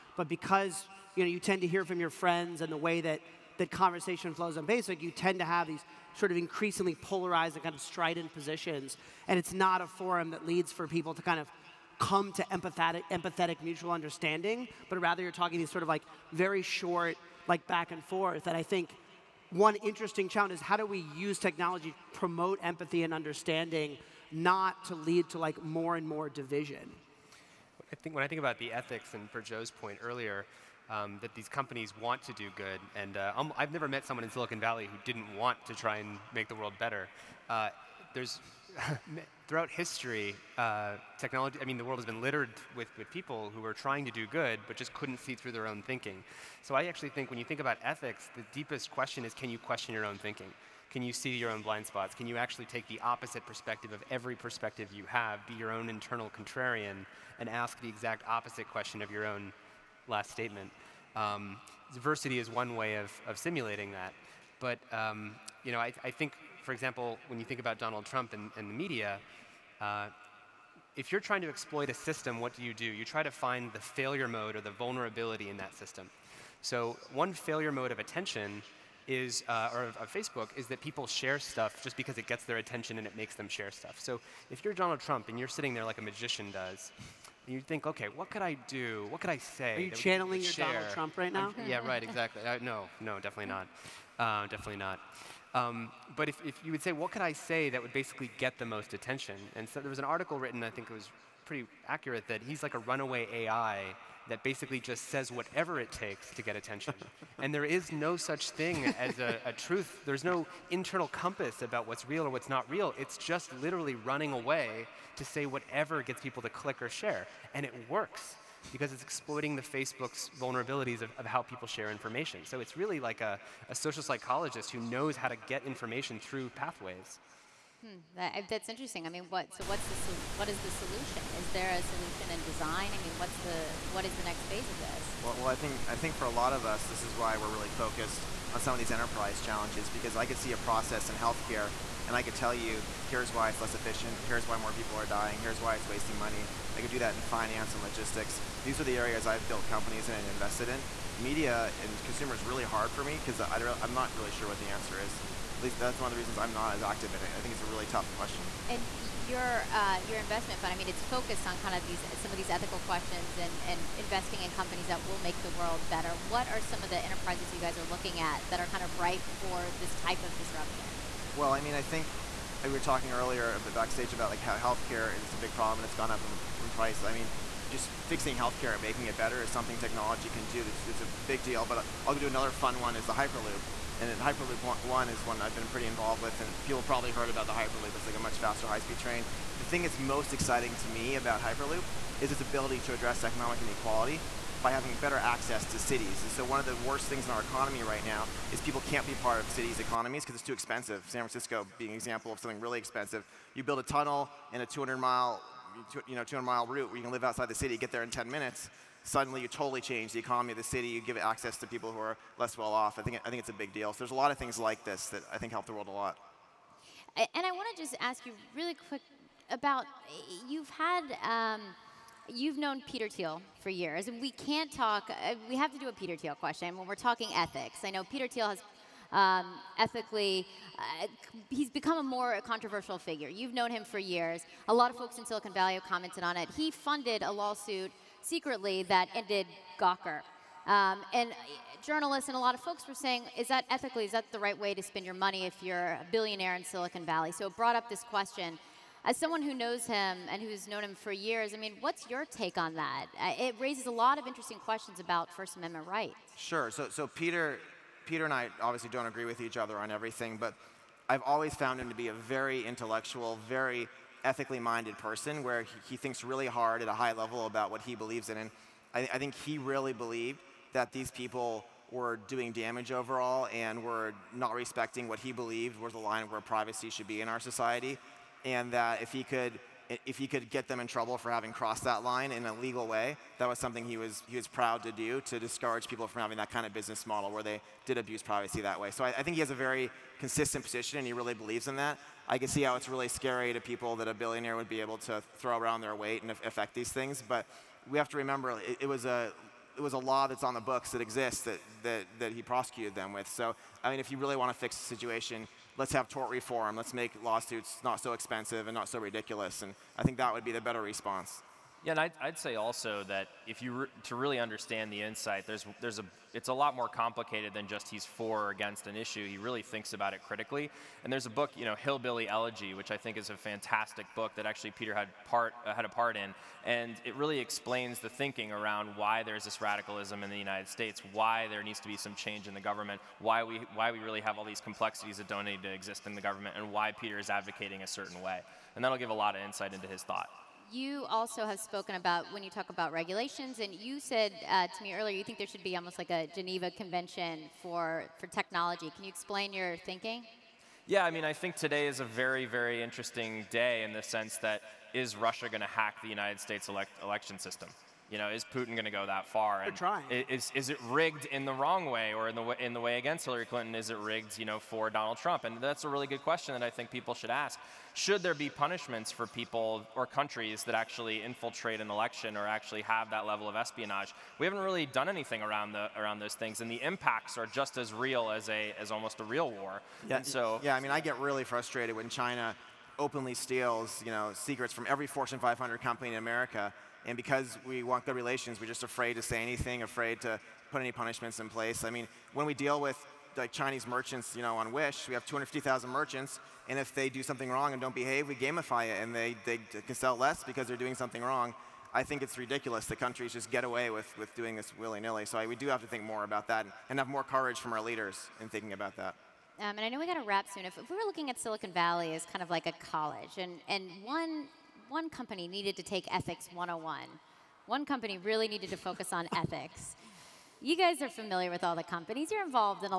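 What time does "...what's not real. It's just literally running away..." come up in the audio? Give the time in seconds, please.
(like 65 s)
112 s.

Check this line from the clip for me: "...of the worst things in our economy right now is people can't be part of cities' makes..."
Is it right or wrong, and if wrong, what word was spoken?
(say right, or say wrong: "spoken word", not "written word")
wrong: "economies", not "makes".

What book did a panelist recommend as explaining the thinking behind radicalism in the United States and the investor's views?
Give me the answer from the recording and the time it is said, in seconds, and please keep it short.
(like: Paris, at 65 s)
Hillbilly Elegy, at 321 s.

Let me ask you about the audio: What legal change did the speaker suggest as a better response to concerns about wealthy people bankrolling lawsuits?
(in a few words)
Tort reform.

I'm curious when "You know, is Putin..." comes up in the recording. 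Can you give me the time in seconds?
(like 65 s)
358 s.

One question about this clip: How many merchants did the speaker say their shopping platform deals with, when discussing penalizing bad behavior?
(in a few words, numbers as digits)
250,000.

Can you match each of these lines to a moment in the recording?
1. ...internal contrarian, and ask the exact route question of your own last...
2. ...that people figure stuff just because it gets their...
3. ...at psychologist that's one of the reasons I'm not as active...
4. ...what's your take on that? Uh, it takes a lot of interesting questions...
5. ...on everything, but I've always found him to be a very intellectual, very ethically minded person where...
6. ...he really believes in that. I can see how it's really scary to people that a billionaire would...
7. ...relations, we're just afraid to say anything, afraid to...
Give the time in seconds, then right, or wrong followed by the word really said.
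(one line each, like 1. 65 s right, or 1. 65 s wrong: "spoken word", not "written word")
1. 55 s wrong: "opposite", not "route"
2. 80 s wrong: "share", not "figure"
3. 155 s wrong: "least", not "psychologist"
4. 251 s wrong: "raises", not "takes"
5. 259 s right
6. 291 s right
7. 388 s right.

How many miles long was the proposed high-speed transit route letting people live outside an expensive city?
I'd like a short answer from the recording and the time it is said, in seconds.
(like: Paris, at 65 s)
200, at 206 s.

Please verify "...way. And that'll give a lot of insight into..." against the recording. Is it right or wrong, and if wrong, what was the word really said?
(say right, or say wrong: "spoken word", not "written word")
right.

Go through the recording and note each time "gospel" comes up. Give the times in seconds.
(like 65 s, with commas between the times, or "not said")
not said.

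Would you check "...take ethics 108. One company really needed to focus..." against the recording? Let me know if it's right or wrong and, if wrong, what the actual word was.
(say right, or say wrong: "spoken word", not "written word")
wrong: "101", not "108".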